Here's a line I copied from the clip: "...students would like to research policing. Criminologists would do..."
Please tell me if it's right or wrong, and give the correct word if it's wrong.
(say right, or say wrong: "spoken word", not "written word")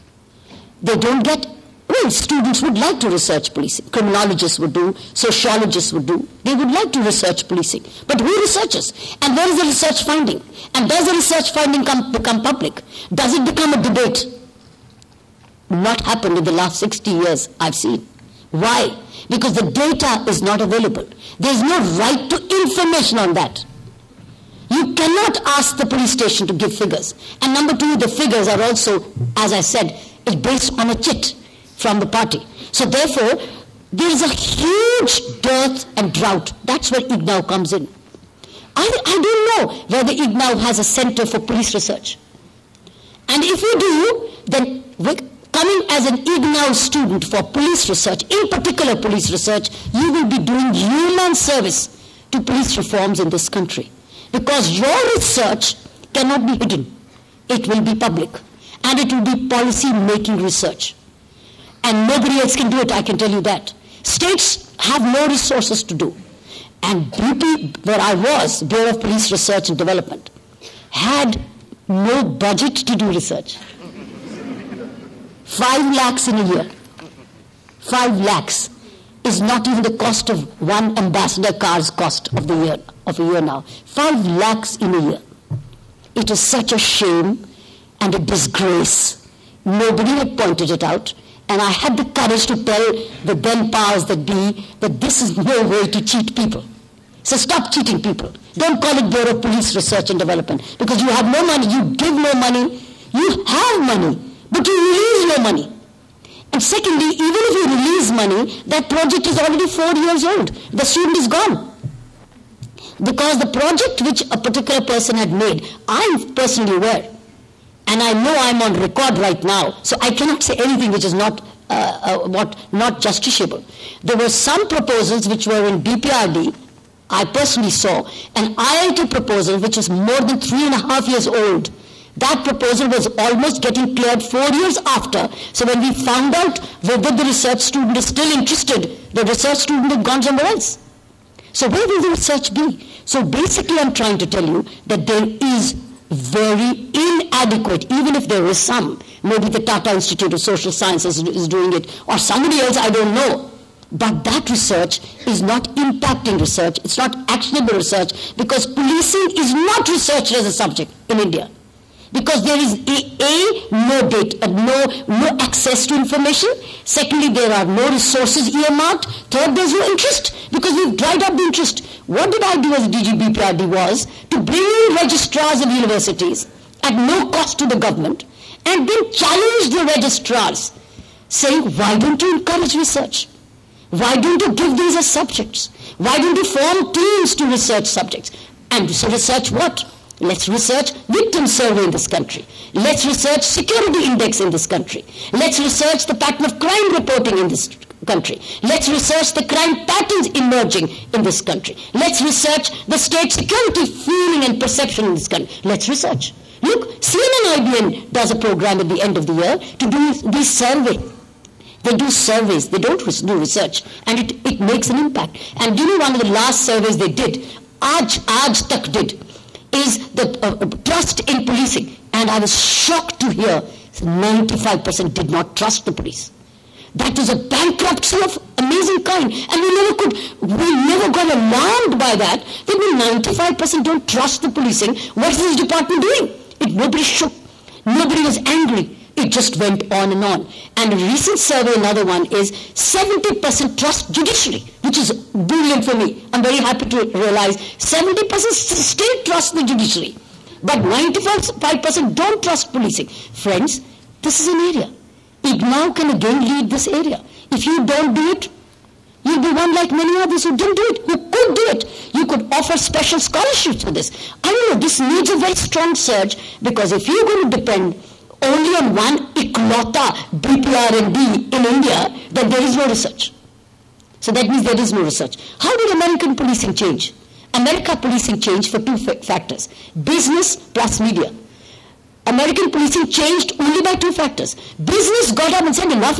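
right.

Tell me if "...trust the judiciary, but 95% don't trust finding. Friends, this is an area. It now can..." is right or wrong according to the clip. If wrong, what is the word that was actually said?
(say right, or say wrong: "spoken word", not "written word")
wrong: "policing", not "finding".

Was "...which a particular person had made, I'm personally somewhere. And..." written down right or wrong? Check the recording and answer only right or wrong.
wrong.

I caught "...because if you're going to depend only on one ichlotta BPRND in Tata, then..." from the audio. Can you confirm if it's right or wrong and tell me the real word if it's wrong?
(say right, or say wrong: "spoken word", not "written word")
wrong: "India", not "Tata".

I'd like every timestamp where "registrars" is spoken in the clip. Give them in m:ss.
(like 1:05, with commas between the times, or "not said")
2:54, 2:59.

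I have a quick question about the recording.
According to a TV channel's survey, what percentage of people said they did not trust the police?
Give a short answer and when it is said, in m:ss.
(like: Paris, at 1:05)
95%, at 3:43.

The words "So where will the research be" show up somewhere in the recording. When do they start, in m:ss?
2:21.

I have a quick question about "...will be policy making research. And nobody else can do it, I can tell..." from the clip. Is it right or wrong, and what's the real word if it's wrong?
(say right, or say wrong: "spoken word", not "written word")
right.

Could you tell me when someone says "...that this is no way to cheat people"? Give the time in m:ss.
1:34.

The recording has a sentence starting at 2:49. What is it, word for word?
Third, there's no interest because we've dried up the interest.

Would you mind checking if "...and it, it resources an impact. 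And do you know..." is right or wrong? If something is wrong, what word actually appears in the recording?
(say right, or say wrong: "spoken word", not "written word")
wrong: "makes", not "resources".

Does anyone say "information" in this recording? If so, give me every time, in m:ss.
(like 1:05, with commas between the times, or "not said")
0:22, 2:45.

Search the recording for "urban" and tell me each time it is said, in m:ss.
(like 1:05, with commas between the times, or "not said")
not said.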